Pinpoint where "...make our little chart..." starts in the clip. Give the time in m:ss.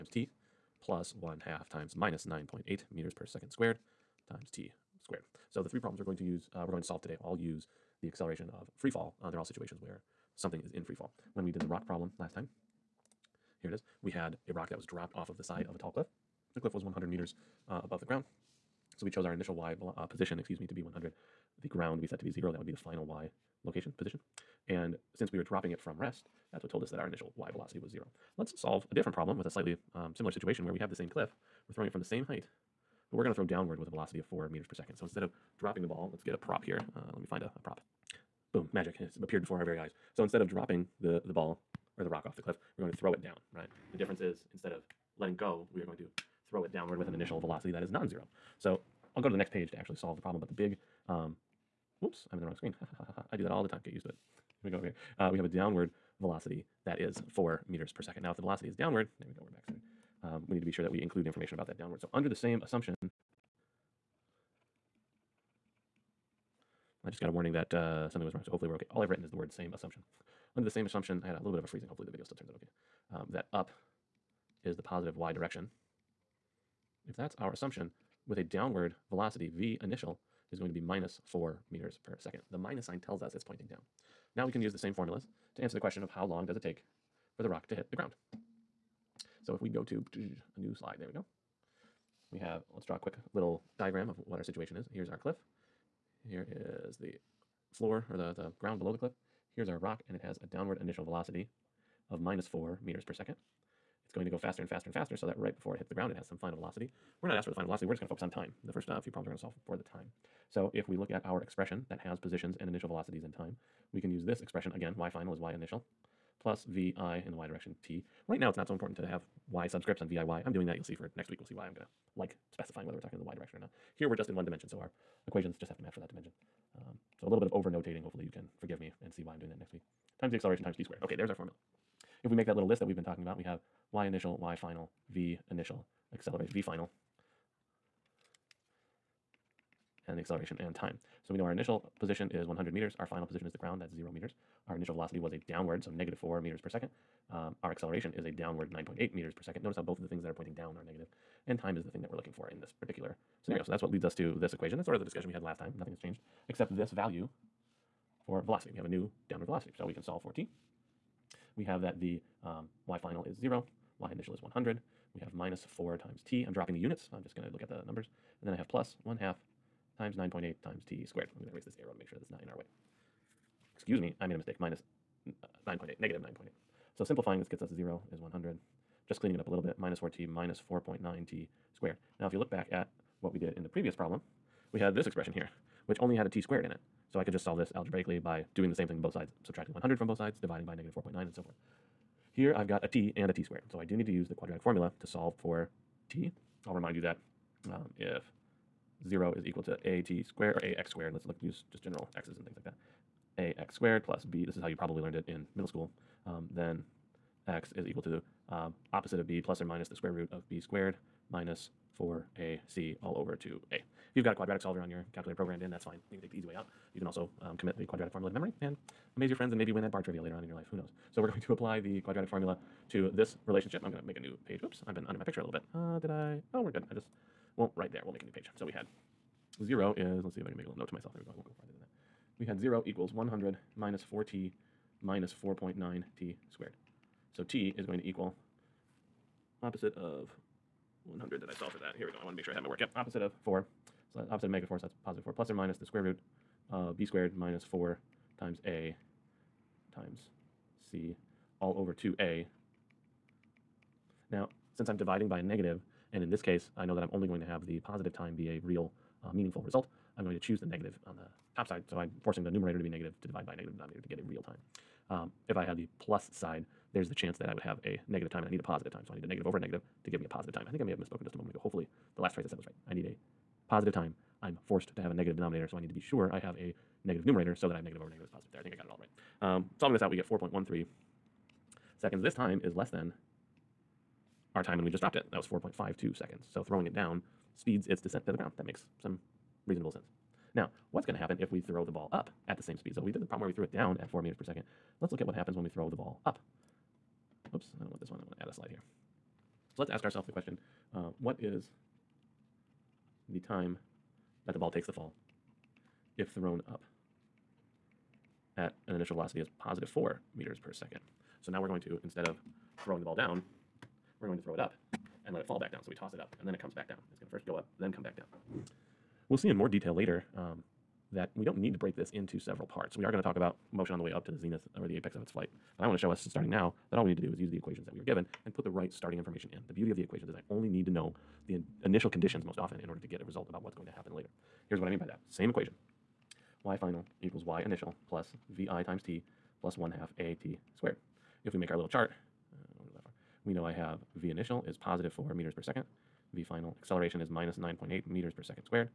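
5:41.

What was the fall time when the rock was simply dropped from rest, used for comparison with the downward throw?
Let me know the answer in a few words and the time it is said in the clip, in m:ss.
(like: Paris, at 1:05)
4.52 seconds, at 4:45.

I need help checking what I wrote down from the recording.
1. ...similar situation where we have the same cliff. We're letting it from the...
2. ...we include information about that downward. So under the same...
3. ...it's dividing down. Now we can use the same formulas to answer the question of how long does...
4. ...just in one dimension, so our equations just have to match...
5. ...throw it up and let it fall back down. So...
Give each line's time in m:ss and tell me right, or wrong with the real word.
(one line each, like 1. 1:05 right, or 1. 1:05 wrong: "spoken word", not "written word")
1. 0:30 wrong: "throwing", not "letting"
2. 1:00 right
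3. 1:23 wrong: "pointing", not "dividing"
4. 2:04 right
5. 5:14 right.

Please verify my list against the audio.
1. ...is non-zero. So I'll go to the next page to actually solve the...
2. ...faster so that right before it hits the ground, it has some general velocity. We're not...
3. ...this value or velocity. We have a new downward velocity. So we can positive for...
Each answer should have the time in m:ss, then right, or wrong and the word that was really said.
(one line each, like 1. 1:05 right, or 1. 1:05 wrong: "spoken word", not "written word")
1. 0:47 right
2. 1:44 wrong: "final", not "general"
3. 2:36 wrong: "solve", not "positive".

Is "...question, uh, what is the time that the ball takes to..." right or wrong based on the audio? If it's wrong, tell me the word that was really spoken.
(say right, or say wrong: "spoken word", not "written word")
right.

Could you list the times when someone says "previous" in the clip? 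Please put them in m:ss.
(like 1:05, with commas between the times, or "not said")
3:03.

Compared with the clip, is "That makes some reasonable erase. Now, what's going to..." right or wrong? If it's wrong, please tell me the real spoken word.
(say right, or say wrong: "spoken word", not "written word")
wrong: "sense", not "erase".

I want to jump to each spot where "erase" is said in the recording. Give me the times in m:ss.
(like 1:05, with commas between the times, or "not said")
2:51.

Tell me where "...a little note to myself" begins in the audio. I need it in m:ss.
3:50.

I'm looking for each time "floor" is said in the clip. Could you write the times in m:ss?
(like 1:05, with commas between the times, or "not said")
1:37.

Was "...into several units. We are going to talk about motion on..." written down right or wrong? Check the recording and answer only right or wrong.
wrong.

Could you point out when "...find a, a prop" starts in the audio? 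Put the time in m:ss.
0:37.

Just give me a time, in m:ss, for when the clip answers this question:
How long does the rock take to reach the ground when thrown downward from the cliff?
4:40.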